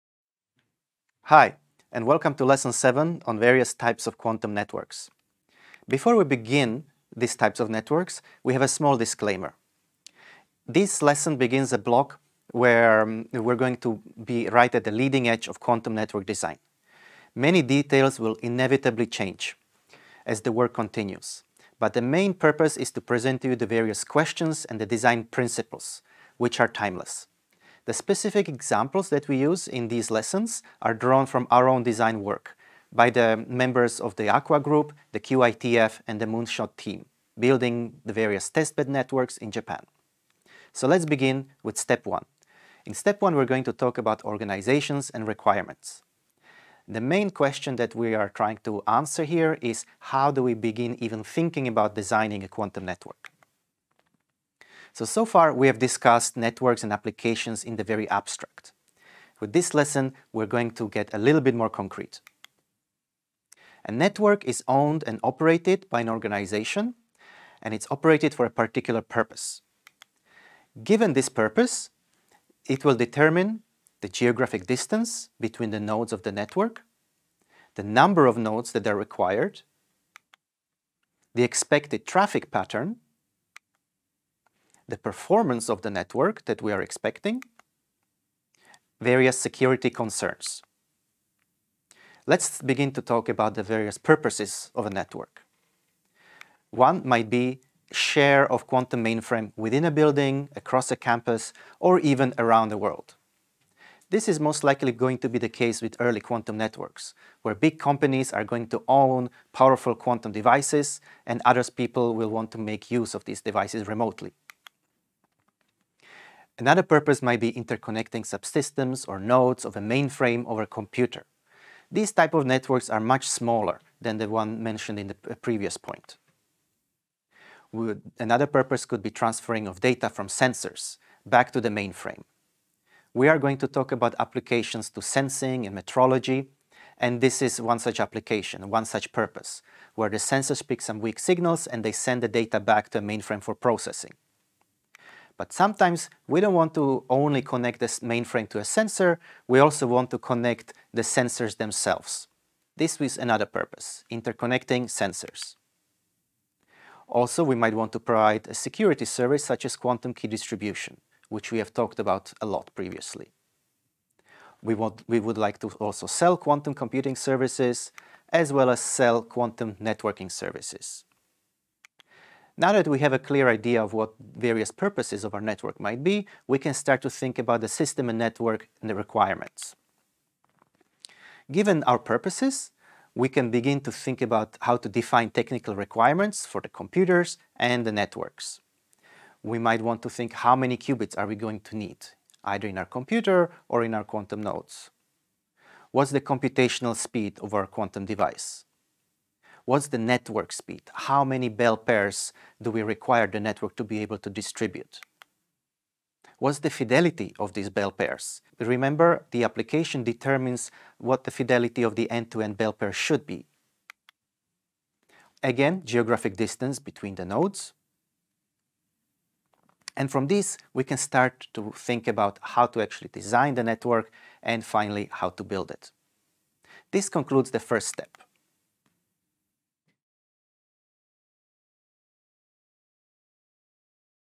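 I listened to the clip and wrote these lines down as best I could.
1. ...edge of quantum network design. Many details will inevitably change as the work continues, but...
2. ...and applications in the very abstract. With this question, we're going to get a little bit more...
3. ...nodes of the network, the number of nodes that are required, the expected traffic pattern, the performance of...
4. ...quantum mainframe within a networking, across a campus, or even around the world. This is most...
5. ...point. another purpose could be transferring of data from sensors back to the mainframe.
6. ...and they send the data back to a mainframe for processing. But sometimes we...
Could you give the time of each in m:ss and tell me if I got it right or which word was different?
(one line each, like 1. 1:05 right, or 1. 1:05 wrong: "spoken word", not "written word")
1. 0:15 right
2. 0:56 wrong: "lesson", not "question"
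3. 1:15 right
4. 1:38 wrong: "building", not "networking"
5. 2:05 right
6. 2:21 right.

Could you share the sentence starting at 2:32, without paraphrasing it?
This is another purpose, interconnecting sensors.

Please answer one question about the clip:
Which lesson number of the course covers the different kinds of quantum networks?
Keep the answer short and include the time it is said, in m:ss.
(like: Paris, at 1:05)
7, at 0:02.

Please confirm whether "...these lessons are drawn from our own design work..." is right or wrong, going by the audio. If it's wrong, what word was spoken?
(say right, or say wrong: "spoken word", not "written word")
right.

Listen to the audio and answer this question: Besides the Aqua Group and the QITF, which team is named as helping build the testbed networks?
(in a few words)
The Moonshot team.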